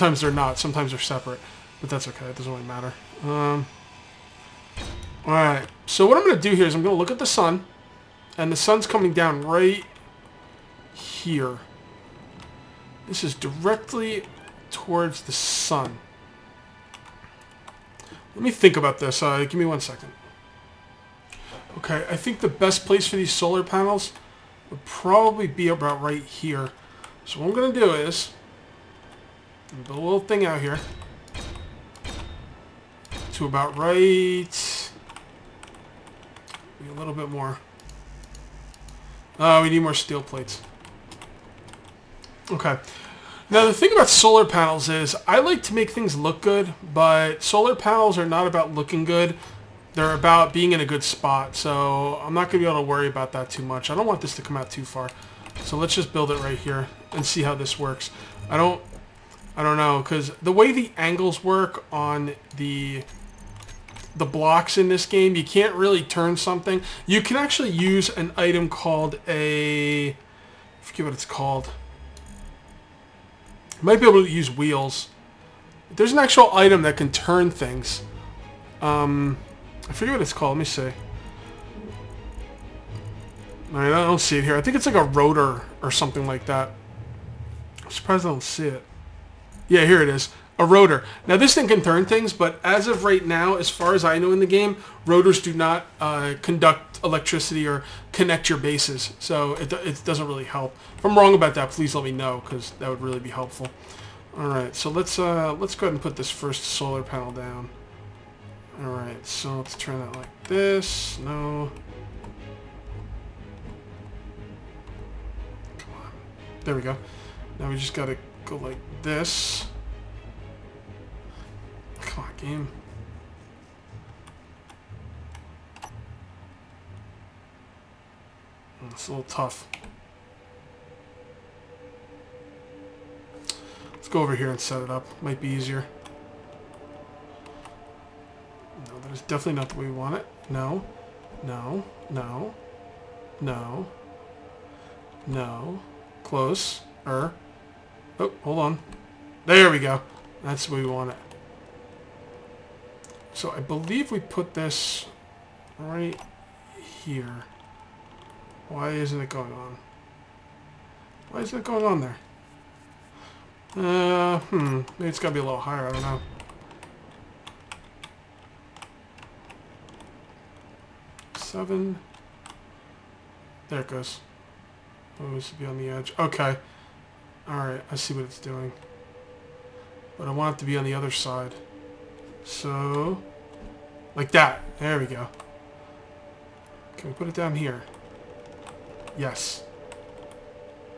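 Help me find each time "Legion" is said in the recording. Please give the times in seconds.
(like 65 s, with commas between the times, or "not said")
not said.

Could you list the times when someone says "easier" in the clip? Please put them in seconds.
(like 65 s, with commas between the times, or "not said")
135 s.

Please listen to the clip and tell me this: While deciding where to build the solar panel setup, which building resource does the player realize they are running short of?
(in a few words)
steel plates.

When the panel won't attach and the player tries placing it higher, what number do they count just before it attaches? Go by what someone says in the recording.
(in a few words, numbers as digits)
7.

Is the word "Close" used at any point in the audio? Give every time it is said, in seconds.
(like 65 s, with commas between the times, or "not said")
146 s.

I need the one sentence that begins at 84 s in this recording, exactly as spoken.
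I think it's like a rotor or something like that.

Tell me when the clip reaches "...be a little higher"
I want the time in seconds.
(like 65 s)
165 s.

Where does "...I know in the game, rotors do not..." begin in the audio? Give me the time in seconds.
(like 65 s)
94 s.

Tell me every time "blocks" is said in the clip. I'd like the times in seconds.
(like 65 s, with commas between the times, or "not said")
64 s.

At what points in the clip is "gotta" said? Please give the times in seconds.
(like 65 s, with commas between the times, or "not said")
117 s.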